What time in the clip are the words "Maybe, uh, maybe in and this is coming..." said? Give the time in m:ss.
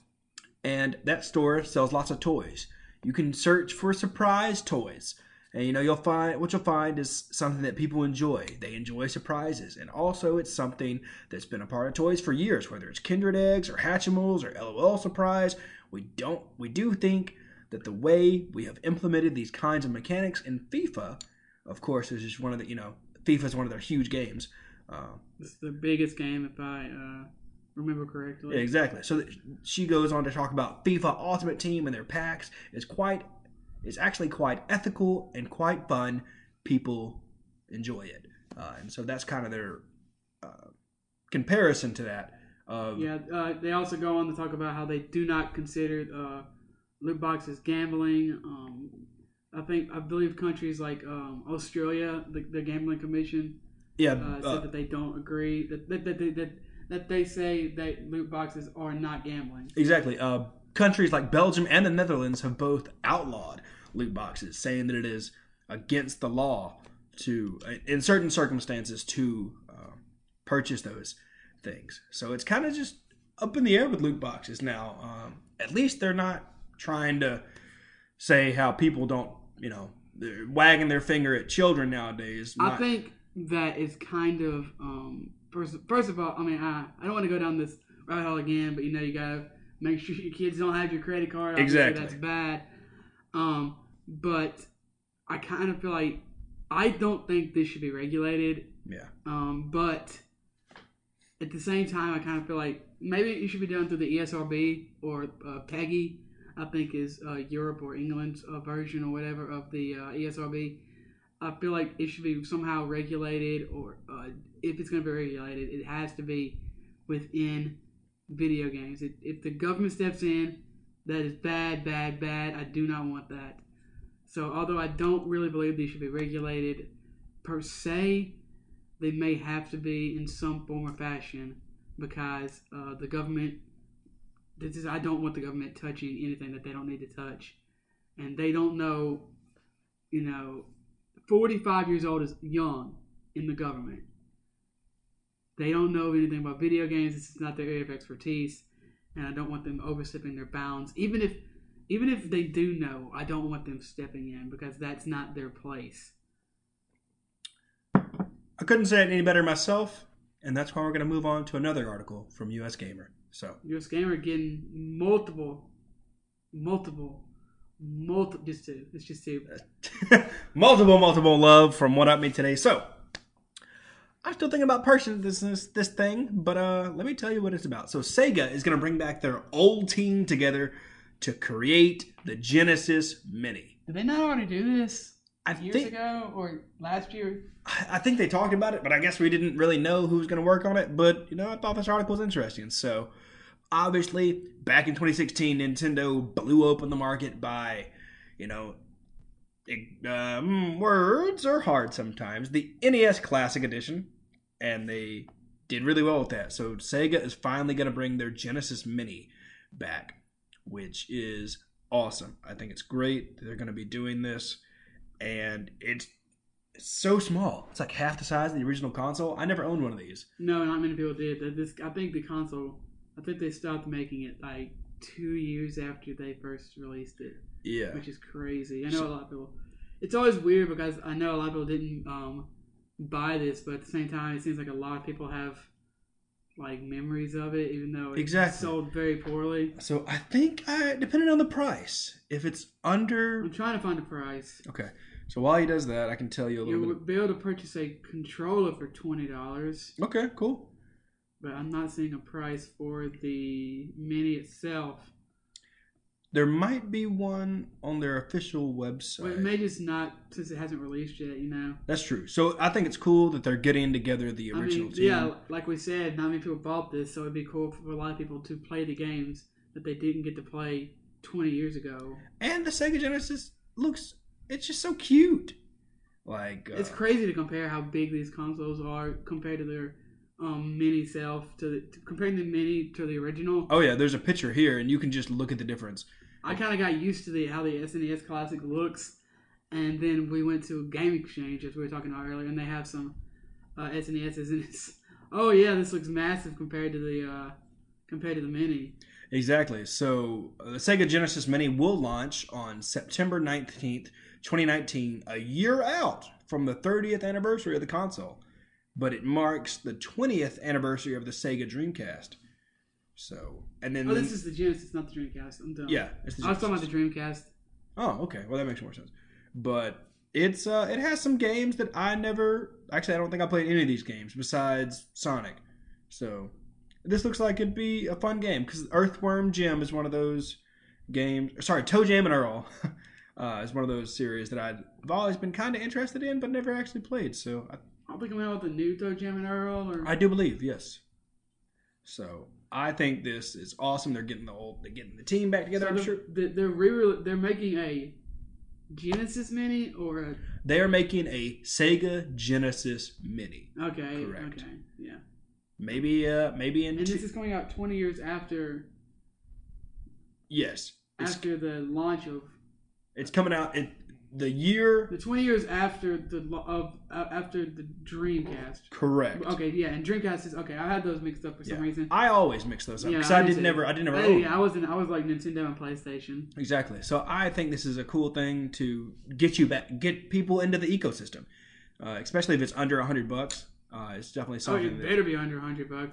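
5:55.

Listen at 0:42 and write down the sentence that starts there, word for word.
Of, yeah, uh, they also go on to talk about how they do not consider uh, loot boxes, gambling.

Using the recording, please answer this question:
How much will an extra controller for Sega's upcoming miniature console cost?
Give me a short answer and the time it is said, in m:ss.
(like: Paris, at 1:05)
$20, at 4:08.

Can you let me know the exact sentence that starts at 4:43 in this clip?
Oh yeah, there's a picture here, and you can just look at the difference.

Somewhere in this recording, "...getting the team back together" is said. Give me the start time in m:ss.
5:44.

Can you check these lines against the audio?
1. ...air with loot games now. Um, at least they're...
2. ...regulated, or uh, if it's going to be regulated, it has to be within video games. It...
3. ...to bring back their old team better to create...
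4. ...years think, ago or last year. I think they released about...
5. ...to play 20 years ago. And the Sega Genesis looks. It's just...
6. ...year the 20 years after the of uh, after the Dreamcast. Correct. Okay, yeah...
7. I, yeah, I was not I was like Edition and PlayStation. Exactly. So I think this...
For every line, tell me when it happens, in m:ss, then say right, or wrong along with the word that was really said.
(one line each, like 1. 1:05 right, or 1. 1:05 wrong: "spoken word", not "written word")
1. 1:13 wrong: "boxes", not "games"
2. 1:52 right
3. 2:58 wrong: "together", not "better"
4. 3:05 wrong: "talked", not "released"
5. 4:30 right
6. 6:04 right
7. 6:14 wrong: "Nintendo", not "Edition".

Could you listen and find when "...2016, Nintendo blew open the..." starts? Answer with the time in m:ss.
3:14.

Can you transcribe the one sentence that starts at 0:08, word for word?
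They enjoy surprises, and also it's something that's been a part of toys for years.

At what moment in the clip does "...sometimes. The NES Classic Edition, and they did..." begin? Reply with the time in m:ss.
3:21.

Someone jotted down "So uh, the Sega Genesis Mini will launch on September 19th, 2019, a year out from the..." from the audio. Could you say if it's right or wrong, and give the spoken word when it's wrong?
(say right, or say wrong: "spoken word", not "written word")
right.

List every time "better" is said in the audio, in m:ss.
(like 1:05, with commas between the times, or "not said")
2:39, 6:25.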